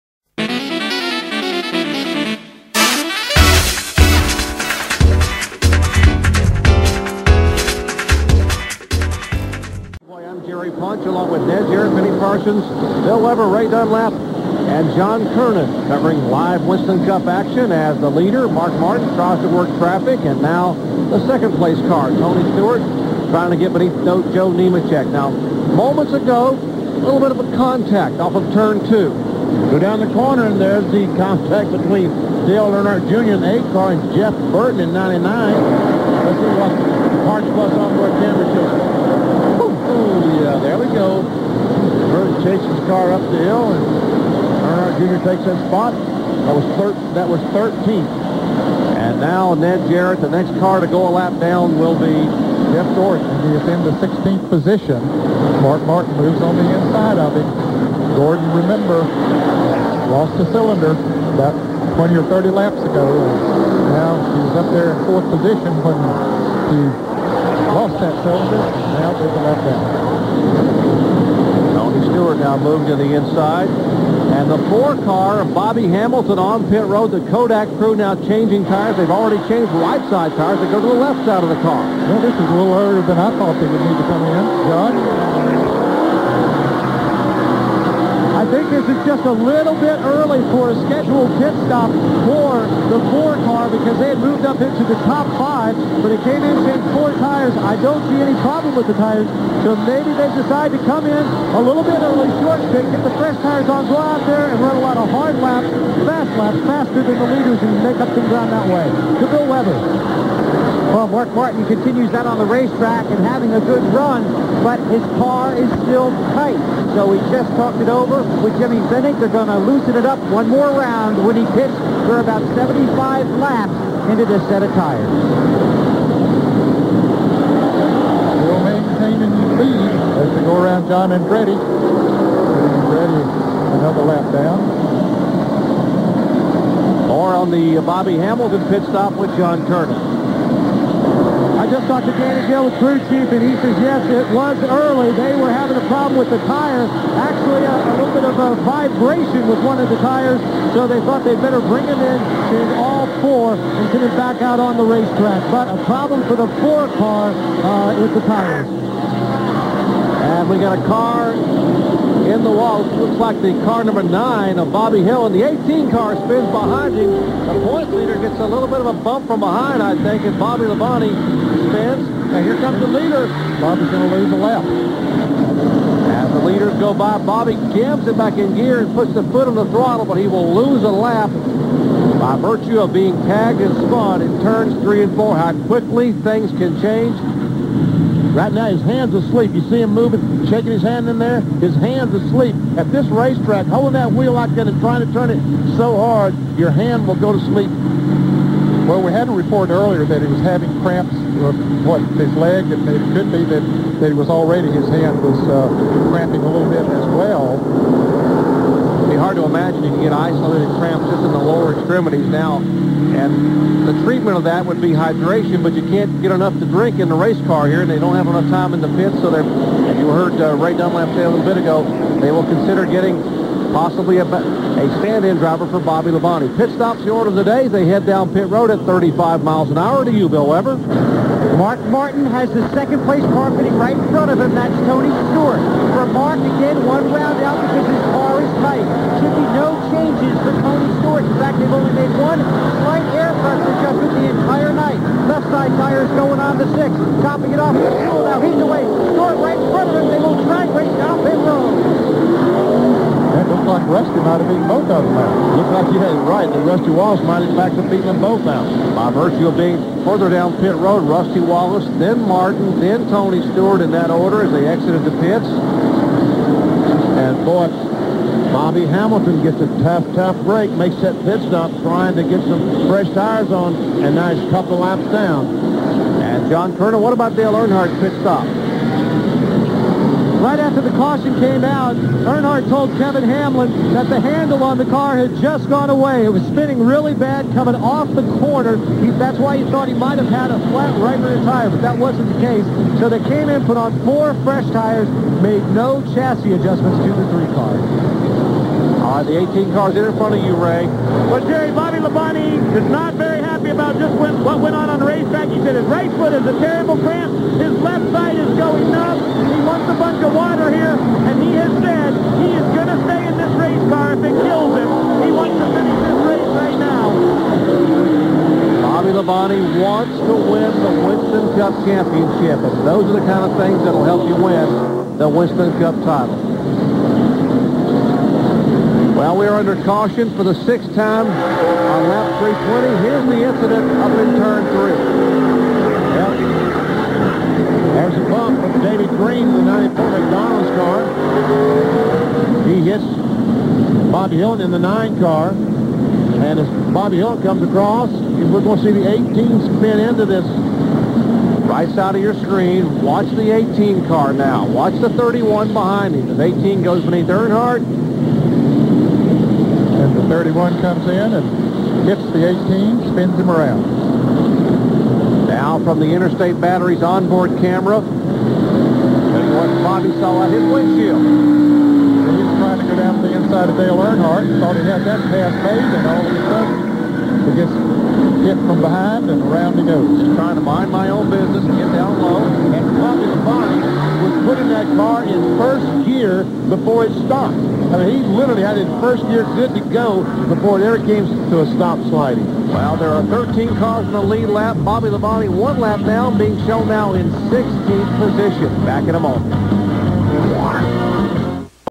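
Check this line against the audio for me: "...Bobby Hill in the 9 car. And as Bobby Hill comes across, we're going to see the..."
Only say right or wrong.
right.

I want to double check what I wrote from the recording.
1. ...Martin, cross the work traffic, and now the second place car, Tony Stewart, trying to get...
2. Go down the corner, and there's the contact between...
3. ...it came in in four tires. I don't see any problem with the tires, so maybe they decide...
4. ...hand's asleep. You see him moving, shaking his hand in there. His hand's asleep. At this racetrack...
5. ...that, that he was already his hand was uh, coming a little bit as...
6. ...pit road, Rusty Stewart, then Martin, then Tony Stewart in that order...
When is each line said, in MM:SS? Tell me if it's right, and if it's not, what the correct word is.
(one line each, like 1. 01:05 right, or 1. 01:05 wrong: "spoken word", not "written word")
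1. 00:18 right
2. 00:29 right
3. 01:36 right
4. 03:08 right
5. 03:23 wrong: "cramping", not "coming"
6. 04:20 wrong: "Wallace", not "Stewart".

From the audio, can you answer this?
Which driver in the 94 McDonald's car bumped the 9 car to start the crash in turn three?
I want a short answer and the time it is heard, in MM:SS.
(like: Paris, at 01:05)
David Green, at 05:38.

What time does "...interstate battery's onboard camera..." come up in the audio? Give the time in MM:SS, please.
06:06.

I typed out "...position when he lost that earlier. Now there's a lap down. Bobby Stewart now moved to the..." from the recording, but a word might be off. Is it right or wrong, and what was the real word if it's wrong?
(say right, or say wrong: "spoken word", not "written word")
wrong: "cylinder", not "earlier".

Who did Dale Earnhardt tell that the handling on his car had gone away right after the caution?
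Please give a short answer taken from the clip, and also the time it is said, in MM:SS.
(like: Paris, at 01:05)
Kevin Hamlin, at 04:42.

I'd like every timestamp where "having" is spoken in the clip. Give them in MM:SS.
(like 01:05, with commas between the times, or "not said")
01:53, 02:25, 03:20.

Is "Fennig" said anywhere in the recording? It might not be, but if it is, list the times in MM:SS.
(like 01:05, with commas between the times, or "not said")
01:58.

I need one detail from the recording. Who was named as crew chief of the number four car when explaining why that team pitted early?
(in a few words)
Danny Gill.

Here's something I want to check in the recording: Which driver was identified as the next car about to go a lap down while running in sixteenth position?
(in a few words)
Jeff Gordon.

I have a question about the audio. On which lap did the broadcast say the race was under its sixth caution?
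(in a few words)
320.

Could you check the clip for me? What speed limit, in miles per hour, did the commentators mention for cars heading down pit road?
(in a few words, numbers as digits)
35.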